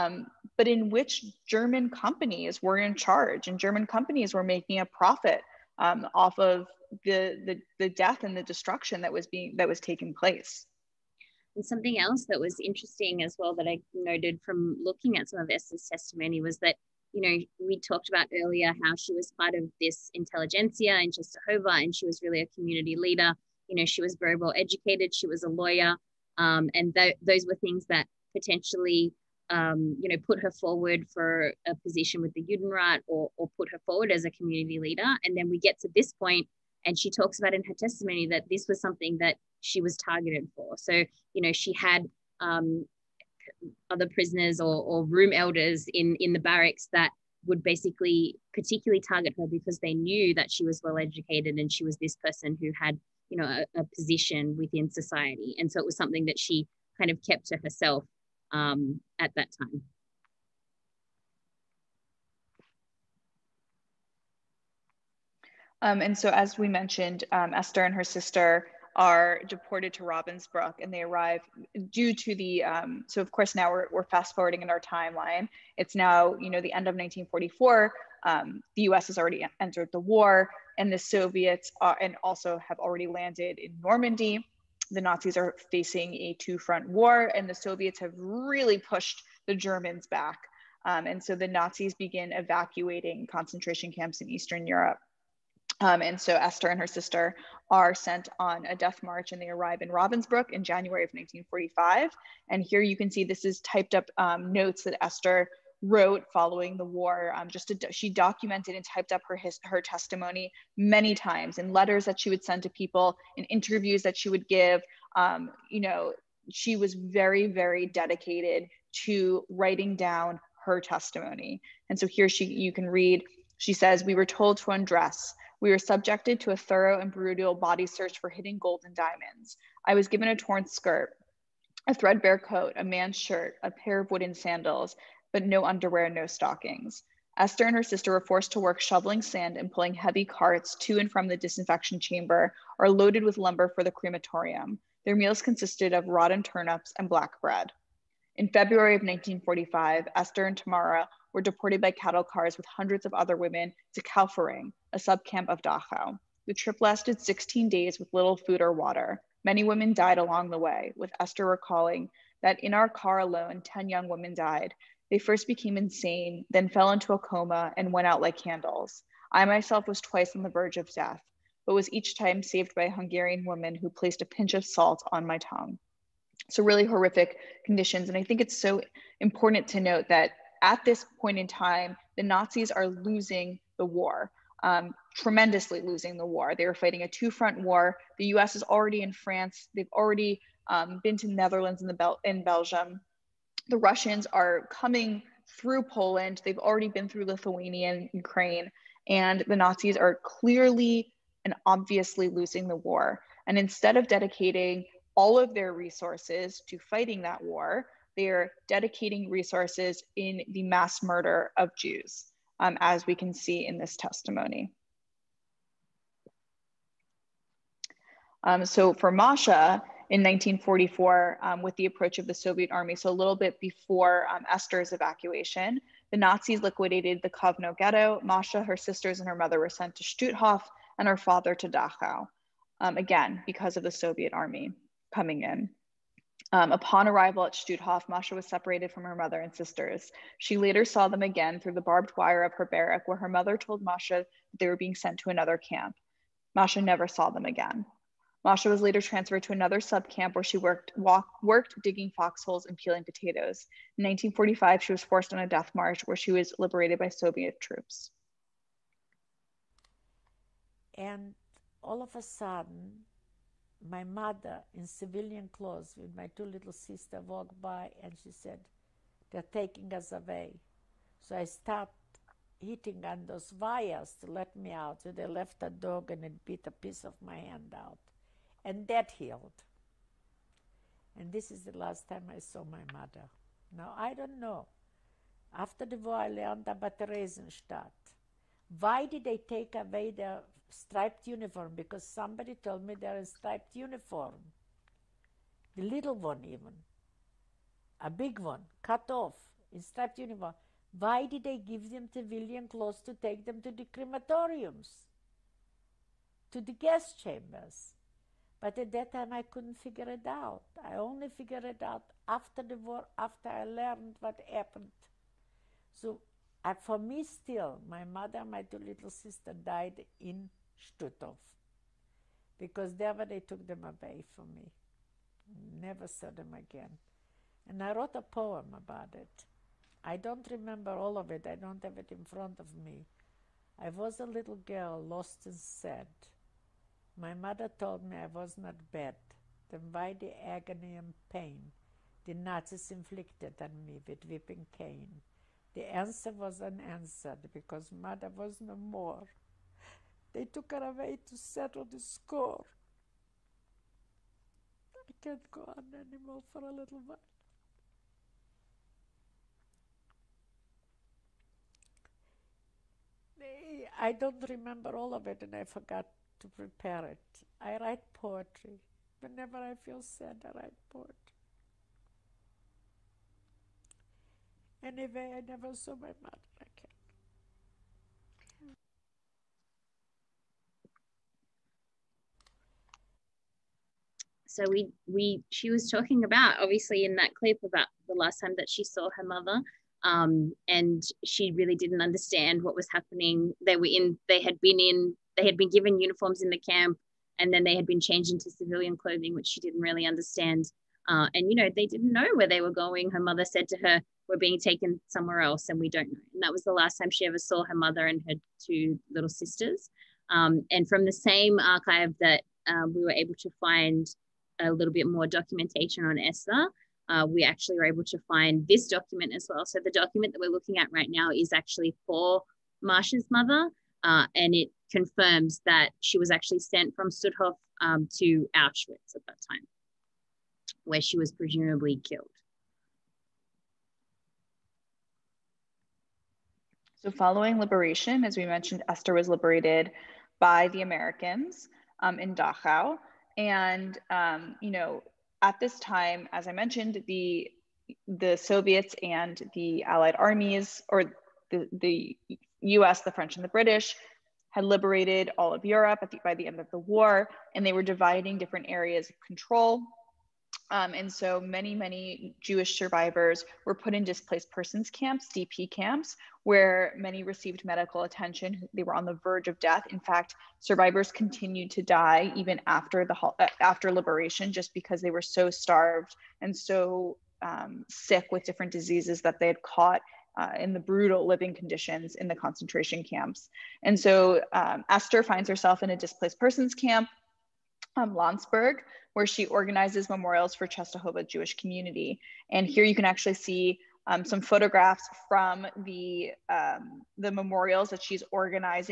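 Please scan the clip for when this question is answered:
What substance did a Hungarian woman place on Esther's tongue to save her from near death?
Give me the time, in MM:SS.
02:54.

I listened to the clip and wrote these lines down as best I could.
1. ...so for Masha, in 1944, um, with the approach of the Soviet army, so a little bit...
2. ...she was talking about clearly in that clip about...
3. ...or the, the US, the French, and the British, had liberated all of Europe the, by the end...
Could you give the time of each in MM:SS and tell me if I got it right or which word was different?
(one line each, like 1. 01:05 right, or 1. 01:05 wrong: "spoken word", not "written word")
1. 03:38 right
2. 06:25 wrong: "obviously", not "clearly"
3. 07:30 right.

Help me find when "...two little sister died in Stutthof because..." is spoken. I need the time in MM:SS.
05:18.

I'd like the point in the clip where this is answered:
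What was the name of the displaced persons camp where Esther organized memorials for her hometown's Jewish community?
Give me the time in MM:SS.
08:08.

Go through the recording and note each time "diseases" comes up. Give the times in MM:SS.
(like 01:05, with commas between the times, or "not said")
07:58.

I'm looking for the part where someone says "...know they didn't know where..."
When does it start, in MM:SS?
06:41.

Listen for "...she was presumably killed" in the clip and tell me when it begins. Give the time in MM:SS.
07:11.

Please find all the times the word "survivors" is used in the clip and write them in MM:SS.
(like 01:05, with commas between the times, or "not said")
07:42, 07:50.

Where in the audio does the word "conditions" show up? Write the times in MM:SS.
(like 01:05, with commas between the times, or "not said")
02:57, 08:01.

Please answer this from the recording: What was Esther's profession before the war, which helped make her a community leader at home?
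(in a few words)
Lawyer.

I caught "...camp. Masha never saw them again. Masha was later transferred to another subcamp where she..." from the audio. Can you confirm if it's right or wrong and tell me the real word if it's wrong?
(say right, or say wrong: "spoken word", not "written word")
right.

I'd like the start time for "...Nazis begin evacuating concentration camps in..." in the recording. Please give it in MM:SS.
01:31.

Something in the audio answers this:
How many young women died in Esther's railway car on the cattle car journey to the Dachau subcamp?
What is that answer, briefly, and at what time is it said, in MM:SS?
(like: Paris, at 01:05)
10, at 02:43.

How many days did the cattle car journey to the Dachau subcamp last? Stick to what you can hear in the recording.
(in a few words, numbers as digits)
16.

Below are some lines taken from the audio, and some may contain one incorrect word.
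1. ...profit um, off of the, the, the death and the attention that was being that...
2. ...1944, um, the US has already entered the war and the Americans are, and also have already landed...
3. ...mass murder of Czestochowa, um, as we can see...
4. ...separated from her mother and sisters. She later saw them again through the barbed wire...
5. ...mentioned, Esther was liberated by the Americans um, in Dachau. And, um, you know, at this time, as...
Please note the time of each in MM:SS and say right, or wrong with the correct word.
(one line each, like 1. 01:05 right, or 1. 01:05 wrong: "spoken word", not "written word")
1. 00:04 wrong: "destruction", not "attention"
2. 01:16 wrong: "Soviets", not "Americans"
3. 03:30 wrong: "Jews", not "Czestochowa"
4. 03:58 right
5. 07:18 right.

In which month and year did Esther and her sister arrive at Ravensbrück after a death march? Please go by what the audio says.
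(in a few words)
January 1945.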